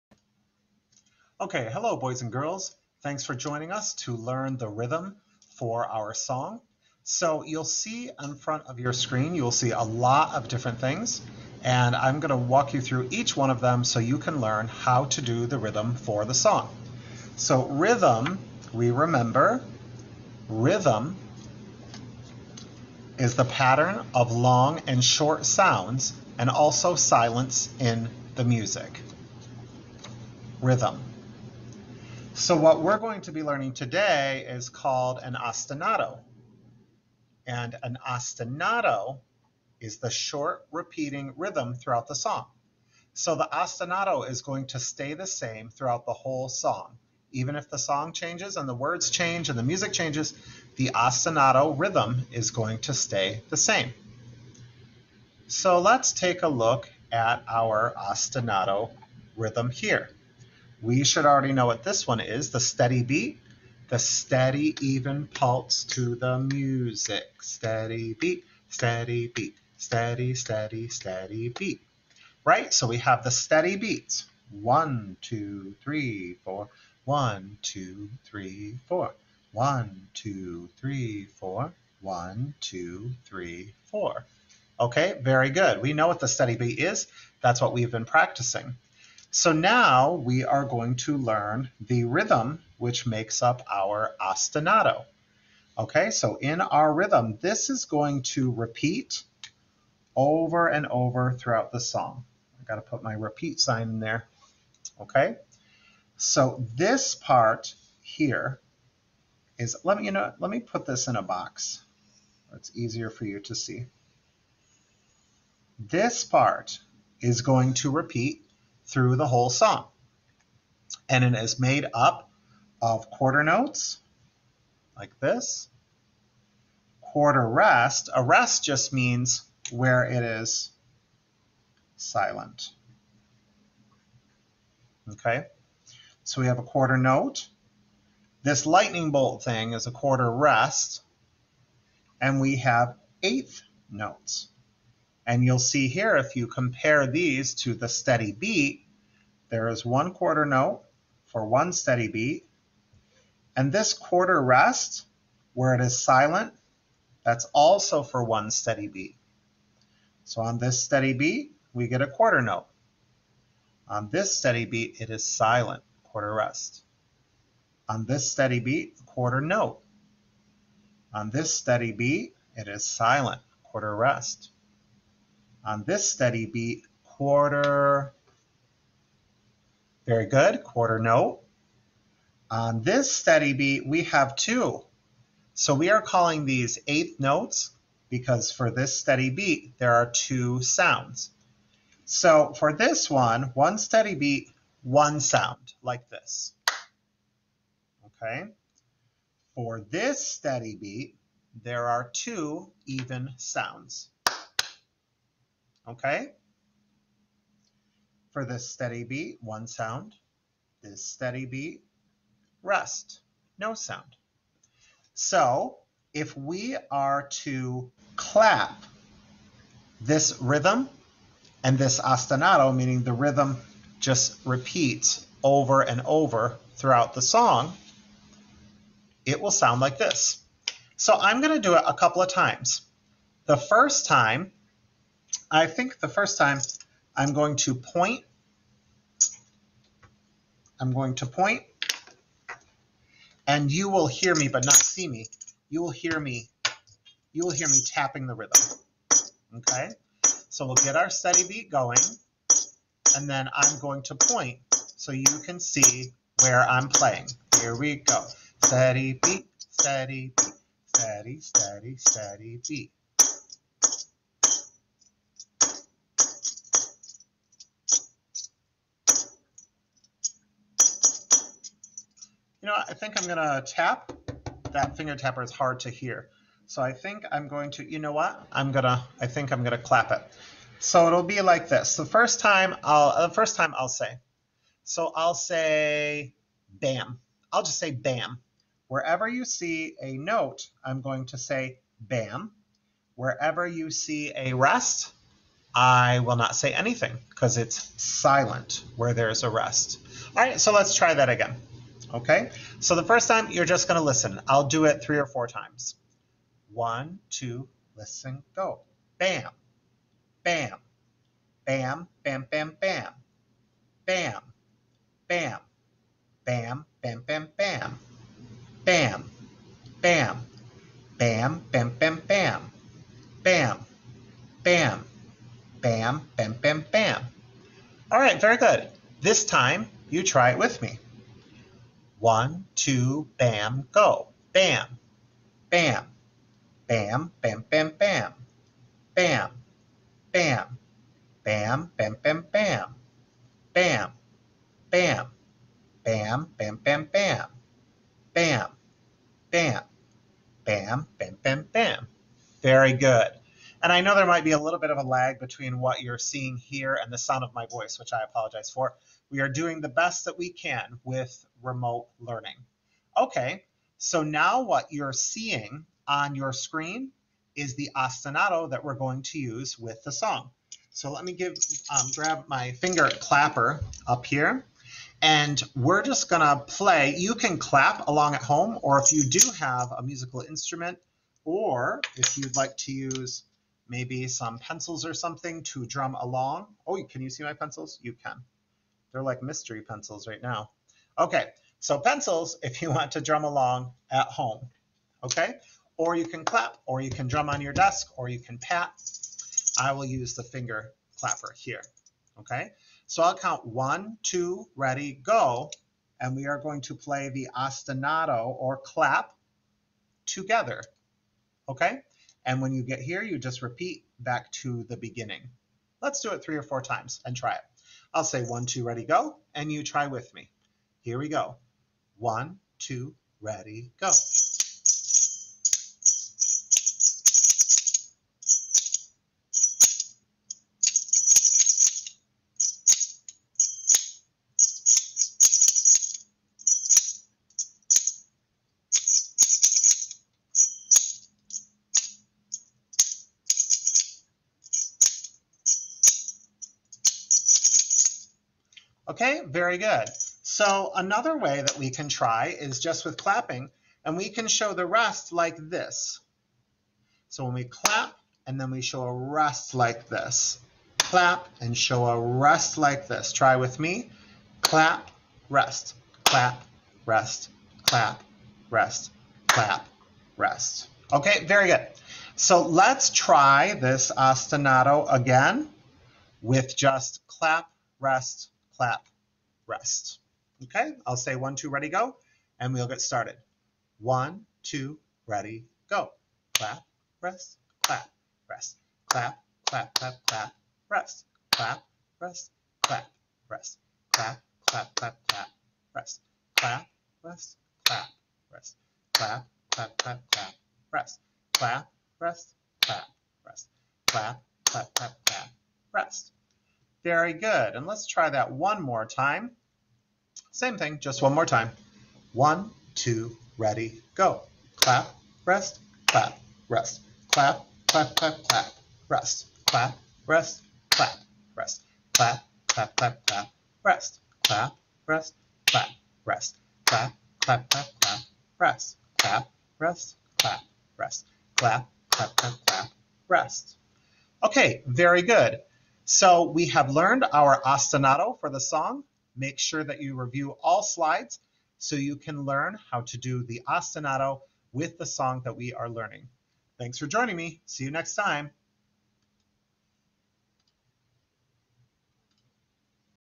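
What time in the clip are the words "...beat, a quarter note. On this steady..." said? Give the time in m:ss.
2:48.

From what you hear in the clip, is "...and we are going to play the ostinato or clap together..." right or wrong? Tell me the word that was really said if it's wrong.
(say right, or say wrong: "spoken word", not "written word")
right.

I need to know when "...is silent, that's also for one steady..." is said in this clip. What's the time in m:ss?
2:35.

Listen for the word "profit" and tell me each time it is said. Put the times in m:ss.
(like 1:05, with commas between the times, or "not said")
not said.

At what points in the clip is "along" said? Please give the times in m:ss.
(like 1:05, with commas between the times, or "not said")
6:18, 6:26, 6:33.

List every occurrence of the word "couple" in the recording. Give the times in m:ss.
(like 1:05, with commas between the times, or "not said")
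3:51.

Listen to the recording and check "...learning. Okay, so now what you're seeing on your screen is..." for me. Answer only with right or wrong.
right.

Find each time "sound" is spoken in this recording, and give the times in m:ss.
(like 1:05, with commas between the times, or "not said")
0:25, 3:10, 3:15, 3:23, 3:29, 3:33, 3:49.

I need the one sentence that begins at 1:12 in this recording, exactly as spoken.
Right, so we have the steady beats.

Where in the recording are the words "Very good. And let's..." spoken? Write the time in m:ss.
8:27.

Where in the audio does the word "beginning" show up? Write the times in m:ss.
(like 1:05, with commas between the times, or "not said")
6:54.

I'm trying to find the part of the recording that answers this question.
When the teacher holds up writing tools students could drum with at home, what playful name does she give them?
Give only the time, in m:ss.
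6:29.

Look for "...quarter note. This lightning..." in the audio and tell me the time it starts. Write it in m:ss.
2:16.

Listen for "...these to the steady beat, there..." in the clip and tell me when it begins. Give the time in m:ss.
2:27.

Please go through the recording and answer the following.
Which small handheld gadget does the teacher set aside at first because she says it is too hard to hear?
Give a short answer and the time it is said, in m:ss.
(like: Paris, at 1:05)
finger tapper, at 4:34.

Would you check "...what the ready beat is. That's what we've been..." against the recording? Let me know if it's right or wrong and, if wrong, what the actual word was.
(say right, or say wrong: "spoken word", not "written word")
wrong: "steady", not "ready".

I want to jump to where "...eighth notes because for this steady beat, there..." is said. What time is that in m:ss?
3:06.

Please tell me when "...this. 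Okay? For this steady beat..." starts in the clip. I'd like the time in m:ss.
3:16.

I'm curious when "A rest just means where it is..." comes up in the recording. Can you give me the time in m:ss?
2:08.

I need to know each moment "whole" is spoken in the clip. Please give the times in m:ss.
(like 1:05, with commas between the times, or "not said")
0:46, 1:59.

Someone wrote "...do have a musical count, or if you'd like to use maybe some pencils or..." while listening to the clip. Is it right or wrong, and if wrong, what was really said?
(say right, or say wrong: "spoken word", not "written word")
wrong: "instrument", not "count".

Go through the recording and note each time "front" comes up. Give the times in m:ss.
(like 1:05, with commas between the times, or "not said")
0:08.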